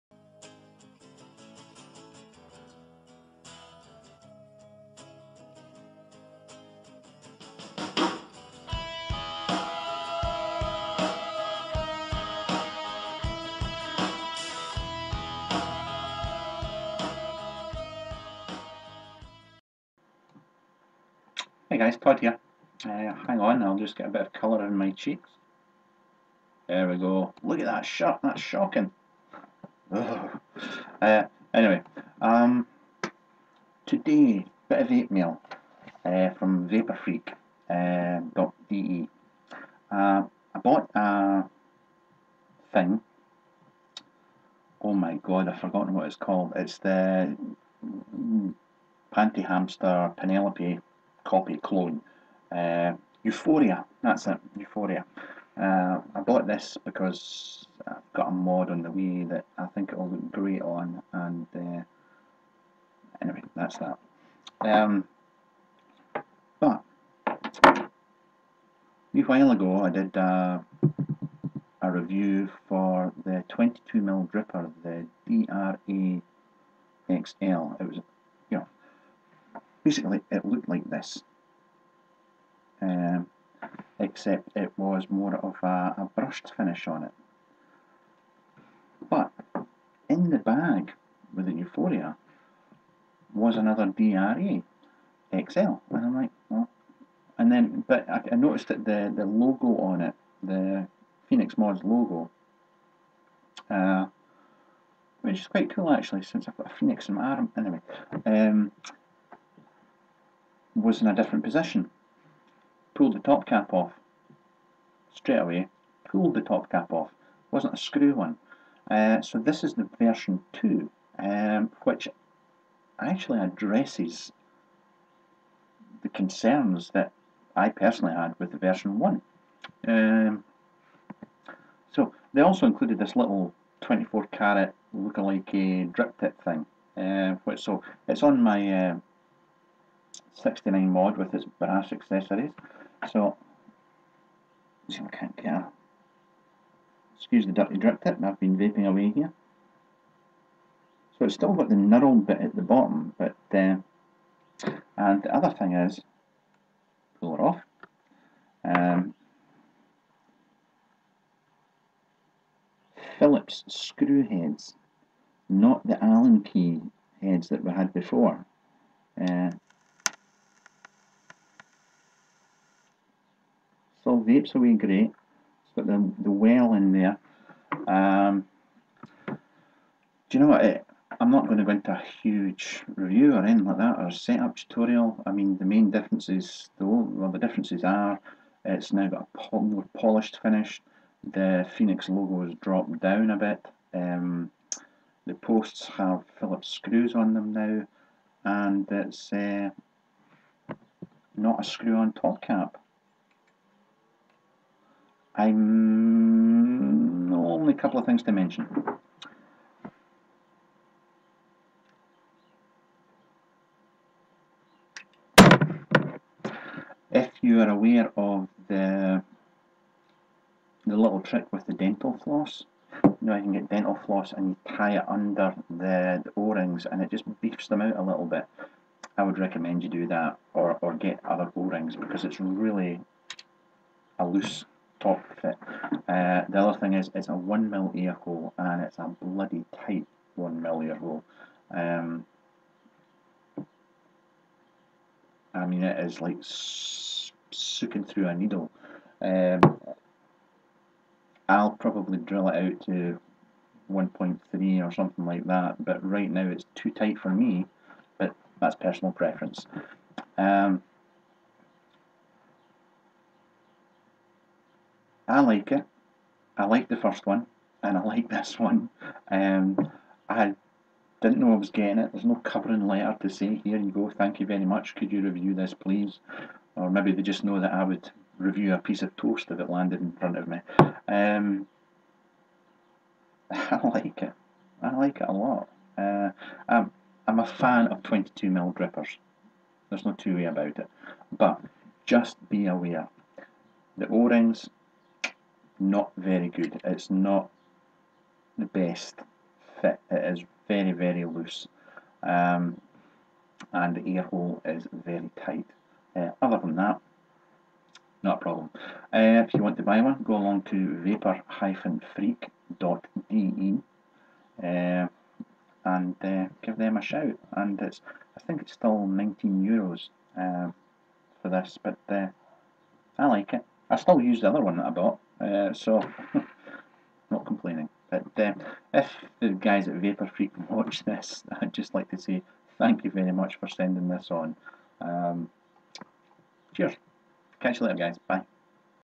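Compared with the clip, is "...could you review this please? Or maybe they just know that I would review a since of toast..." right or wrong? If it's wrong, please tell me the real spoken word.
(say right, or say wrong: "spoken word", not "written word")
wrong: "piece", not "since".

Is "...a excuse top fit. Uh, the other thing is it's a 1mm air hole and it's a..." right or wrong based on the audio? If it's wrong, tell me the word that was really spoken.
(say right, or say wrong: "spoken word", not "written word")
wrong: "loose", not "excuse".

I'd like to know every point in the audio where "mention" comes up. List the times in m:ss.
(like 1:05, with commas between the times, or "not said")
3:28.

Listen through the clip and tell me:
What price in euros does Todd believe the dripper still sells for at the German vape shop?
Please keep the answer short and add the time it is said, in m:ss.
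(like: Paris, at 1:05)
19 euros, at 5:19.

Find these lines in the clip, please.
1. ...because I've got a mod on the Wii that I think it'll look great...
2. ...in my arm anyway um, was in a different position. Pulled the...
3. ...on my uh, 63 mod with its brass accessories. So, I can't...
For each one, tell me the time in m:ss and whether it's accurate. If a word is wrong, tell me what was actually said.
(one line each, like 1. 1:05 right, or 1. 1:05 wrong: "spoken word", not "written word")
1. 0:56 right
2. 1:47 right
3. 2:18 wrong: "69", not "63".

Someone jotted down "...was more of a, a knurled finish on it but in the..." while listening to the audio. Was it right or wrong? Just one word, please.
wrong.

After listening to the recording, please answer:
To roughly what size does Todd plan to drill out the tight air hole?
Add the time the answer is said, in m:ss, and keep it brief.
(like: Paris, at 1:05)
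1.3, at 4:13.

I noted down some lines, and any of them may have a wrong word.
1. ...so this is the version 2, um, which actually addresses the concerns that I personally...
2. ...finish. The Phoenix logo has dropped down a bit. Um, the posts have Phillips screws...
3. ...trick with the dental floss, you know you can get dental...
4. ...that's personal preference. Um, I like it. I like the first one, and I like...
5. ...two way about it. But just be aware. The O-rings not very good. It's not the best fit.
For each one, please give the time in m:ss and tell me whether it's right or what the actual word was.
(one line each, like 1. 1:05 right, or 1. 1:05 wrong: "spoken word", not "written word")
1. 1:59 right
2. 3:10 right
3. 3:41 right
4. 4:18 right
5. 4:50 right.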